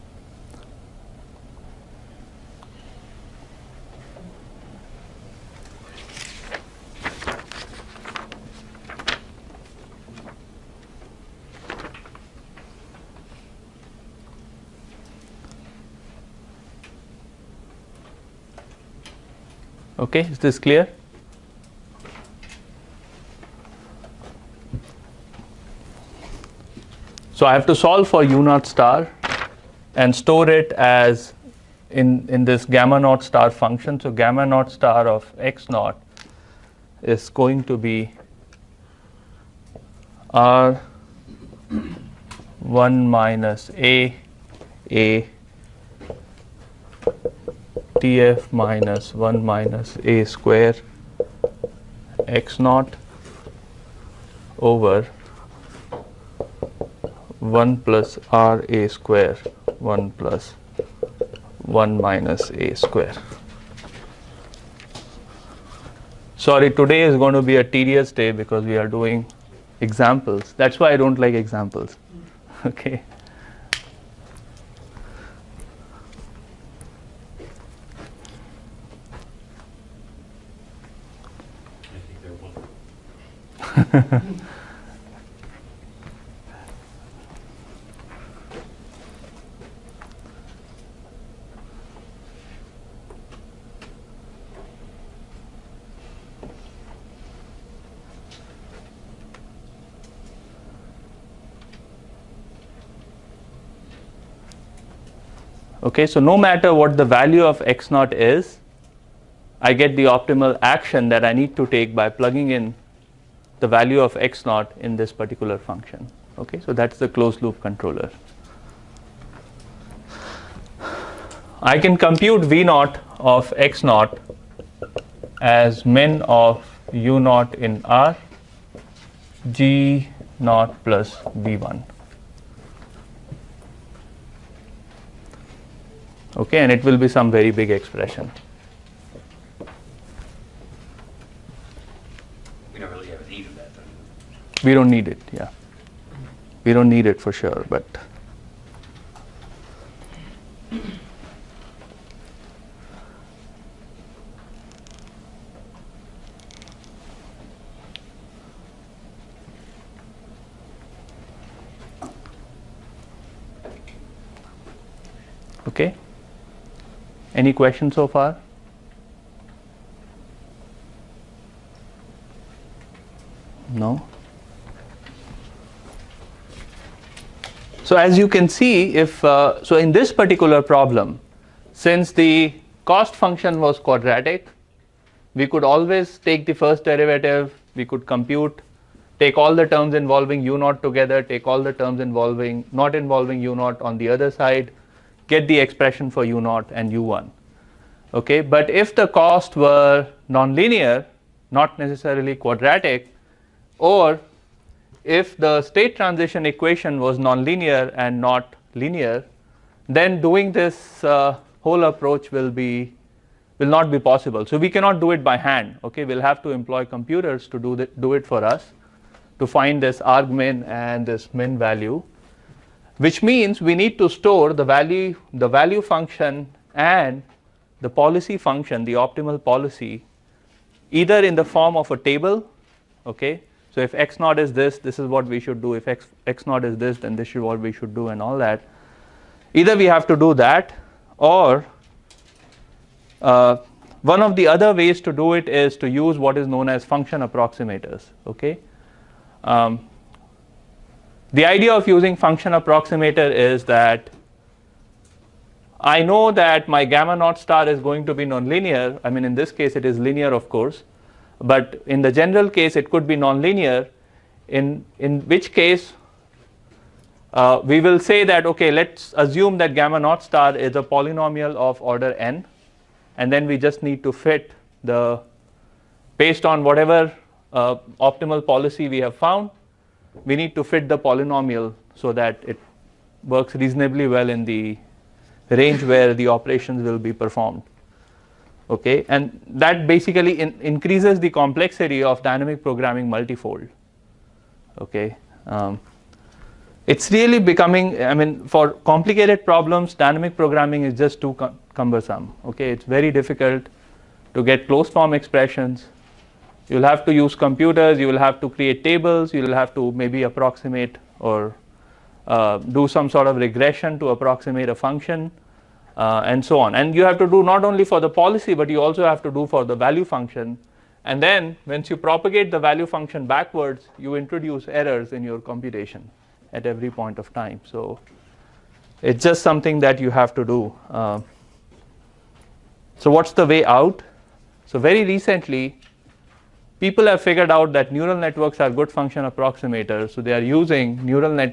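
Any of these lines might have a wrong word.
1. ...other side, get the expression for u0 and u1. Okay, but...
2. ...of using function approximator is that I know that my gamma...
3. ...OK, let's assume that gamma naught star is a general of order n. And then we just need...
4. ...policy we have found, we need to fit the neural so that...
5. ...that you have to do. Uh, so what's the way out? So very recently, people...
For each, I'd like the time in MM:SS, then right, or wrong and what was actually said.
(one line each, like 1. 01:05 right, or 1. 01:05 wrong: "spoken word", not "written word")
1. 03:14 right
2. 04:11 right
3. 04:28 wrong: "polynomial", not "general"
4. 04:38 wrong: "polynomial", not "neural"
5. 05:29 right.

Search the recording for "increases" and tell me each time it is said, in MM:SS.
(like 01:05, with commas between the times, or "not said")
04:50.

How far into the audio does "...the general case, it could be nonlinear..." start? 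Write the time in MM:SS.
04:22.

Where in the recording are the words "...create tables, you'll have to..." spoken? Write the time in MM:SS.
05:08.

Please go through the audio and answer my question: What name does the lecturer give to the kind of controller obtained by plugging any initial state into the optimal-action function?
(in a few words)
closed loop controller.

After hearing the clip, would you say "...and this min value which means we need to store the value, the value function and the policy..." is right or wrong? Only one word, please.
right.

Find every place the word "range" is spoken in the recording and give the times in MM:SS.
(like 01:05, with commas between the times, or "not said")
04:45.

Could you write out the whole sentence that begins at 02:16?
okay and it will be some very big expression we don't really have a need of that do we?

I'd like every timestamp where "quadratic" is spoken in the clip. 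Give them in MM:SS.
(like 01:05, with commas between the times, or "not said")
03:03, 03:22.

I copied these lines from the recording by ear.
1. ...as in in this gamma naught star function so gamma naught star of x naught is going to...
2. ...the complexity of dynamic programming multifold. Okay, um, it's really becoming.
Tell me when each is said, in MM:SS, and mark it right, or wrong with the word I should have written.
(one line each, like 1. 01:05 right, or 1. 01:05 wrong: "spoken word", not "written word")
1. 00:30 right
2. 04:51 right.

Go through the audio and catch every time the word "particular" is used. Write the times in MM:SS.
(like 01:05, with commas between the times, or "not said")
01:55, 03:00.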